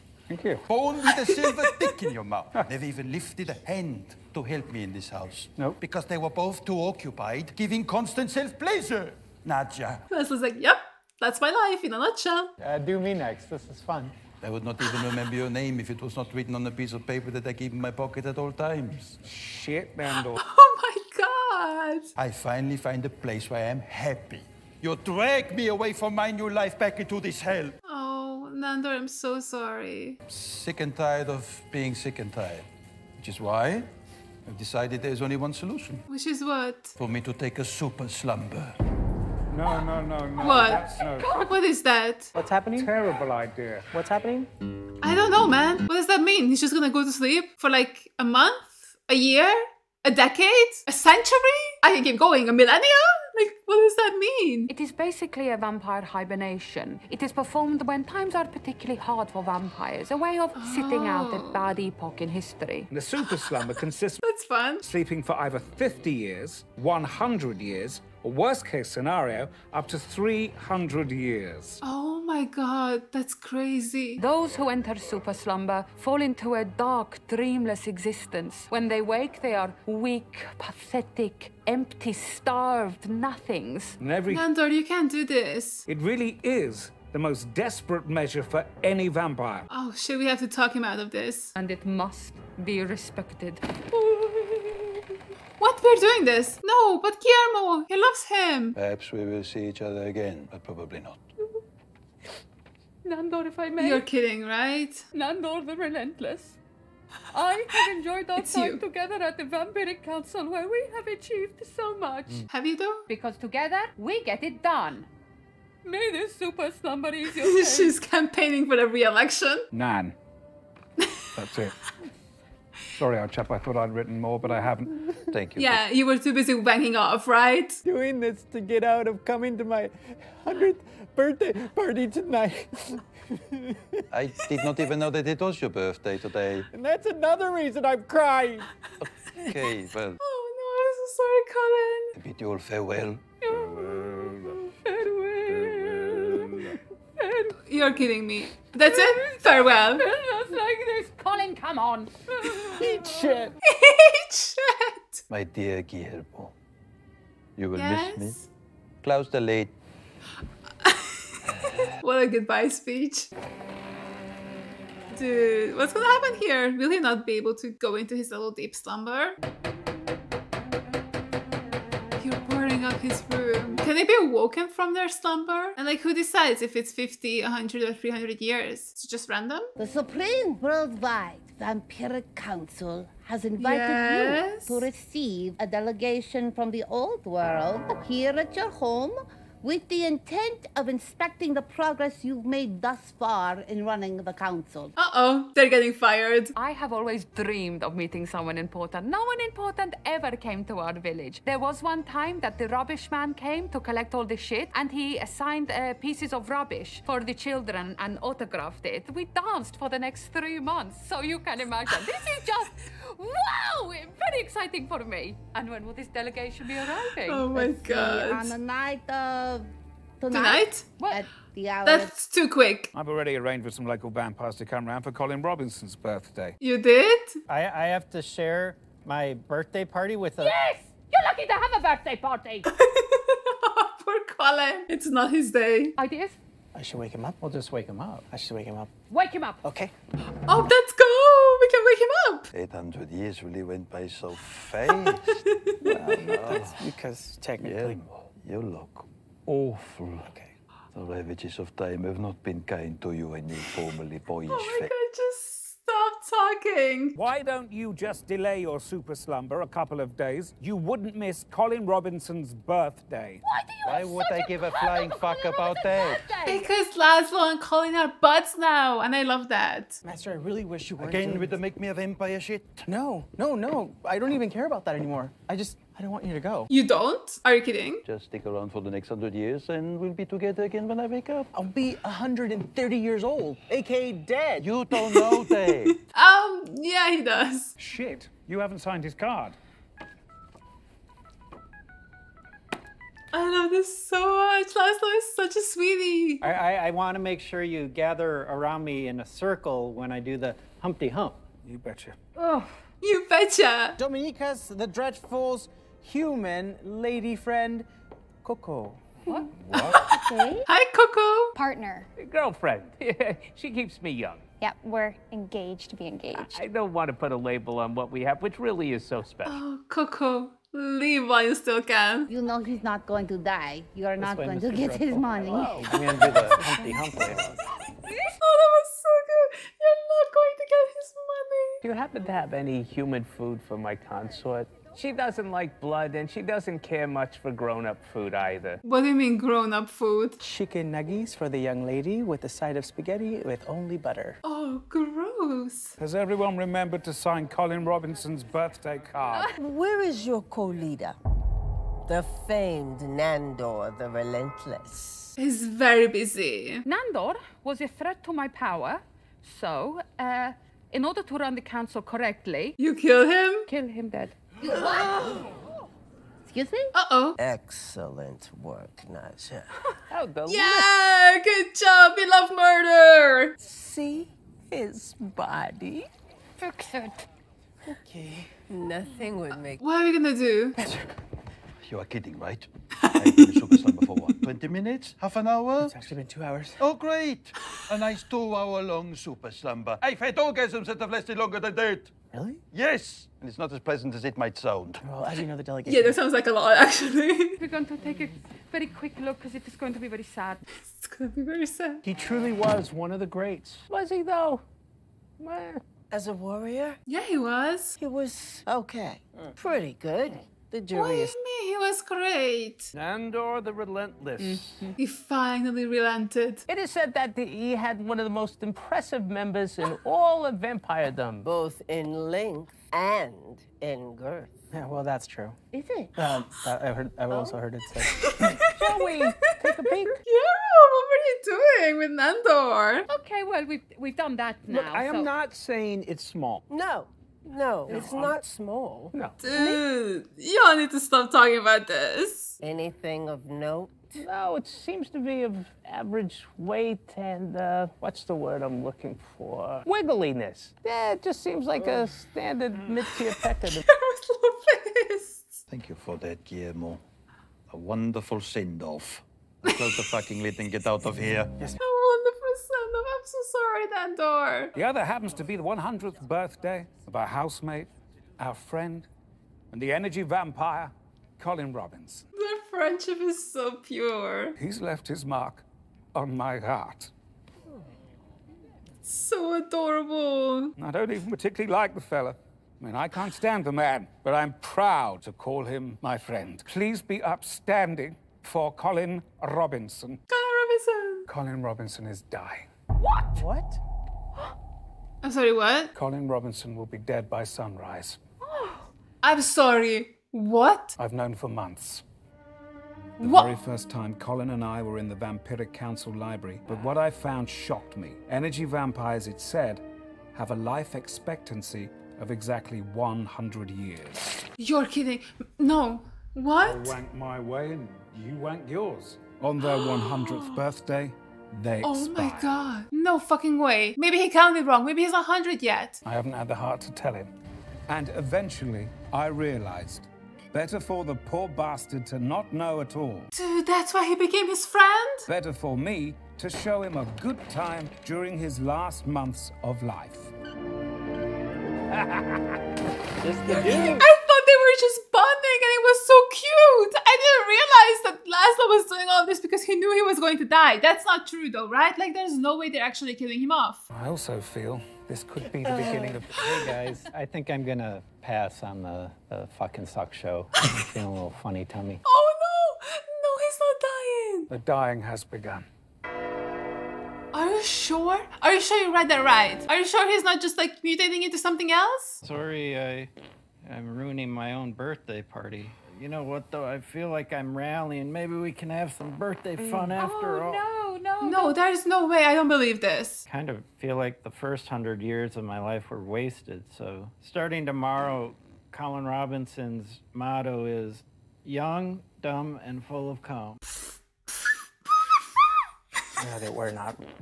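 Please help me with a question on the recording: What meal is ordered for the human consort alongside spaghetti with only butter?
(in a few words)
Chicken nuggies.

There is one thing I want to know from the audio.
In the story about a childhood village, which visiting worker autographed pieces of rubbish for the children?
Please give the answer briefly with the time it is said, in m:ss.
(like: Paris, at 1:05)
the rubbish man, at 3:22.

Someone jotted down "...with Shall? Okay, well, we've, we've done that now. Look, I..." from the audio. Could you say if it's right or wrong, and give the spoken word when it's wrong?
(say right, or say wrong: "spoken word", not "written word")
wrong: "Nandor", not "Shall".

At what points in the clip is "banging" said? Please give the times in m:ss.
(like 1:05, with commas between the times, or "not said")
2:06.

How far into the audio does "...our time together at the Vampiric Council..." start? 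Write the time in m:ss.
1:48.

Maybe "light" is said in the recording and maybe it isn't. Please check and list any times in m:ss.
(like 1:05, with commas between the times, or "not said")
not said.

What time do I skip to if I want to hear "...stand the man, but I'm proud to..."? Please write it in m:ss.
8:03.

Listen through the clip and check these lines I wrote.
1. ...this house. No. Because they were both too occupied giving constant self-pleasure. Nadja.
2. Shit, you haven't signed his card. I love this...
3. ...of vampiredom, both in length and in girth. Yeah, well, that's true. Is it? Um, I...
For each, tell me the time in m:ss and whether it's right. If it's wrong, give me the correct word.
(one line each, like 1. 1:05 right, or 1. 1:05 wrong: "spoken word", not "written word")
1. 0:04 right
2. 4:47 right
3. 7:00 right.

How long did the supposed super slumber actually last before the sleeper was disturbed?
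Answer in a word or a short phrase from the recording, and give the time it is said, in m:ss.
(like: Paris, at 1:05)
2 hours, at 6:26.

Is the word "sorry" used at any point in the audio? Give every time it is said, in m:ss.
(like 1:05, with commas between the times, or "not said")
0:29, 2:02, 2:22, 7:43, 8:15, 8:19, 9:32.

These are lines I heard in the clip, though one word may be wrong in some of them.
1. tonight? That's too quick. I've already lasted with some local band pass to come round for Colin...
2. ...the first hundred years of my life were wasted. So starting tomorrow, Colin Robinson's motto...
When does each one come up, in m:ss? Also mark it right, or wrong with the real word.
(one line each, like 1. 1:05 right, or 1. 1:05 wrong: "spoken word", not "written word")
1. 3:40 wrong: "arranged", not "lasted"
2. 9:44 right.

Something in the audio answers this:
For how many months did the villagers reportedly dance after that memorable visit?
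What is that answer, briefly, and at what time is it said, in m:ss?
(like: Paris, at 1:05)
3 months, at 3:30.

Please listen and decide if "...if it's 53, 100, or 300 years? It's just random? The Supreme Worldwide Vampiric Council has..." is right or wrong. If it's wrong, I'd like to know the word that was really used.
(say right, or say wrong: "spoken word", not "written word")
wrong: "50", not "53".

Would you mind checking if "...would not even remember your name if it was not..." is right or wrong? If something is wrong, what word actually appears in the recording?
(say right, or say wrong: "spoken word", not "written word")
right.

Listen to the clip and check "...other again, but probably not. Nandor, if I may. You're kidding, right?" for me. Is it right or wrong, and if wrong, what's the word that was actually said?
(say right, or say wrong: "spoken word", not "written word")
right.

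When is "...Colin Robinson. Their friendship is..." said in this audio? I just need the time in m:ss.
7:51.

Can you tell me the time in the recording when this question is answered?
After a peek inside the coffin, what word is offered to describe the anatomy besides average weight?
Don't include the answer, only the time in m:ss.
7:29.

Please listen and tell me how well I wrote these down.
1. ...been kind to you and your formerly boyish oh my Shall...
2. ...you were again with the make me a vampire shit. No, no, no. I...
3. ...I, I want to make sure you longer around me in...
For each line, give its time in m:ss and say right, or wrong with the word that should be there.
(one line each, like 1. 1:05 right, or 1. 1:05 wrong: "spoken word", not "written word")
1. 4:12 wrong: "God", not "Shall"
2. 4:30 right
3. 4:56 wrong: "gather", not "longer".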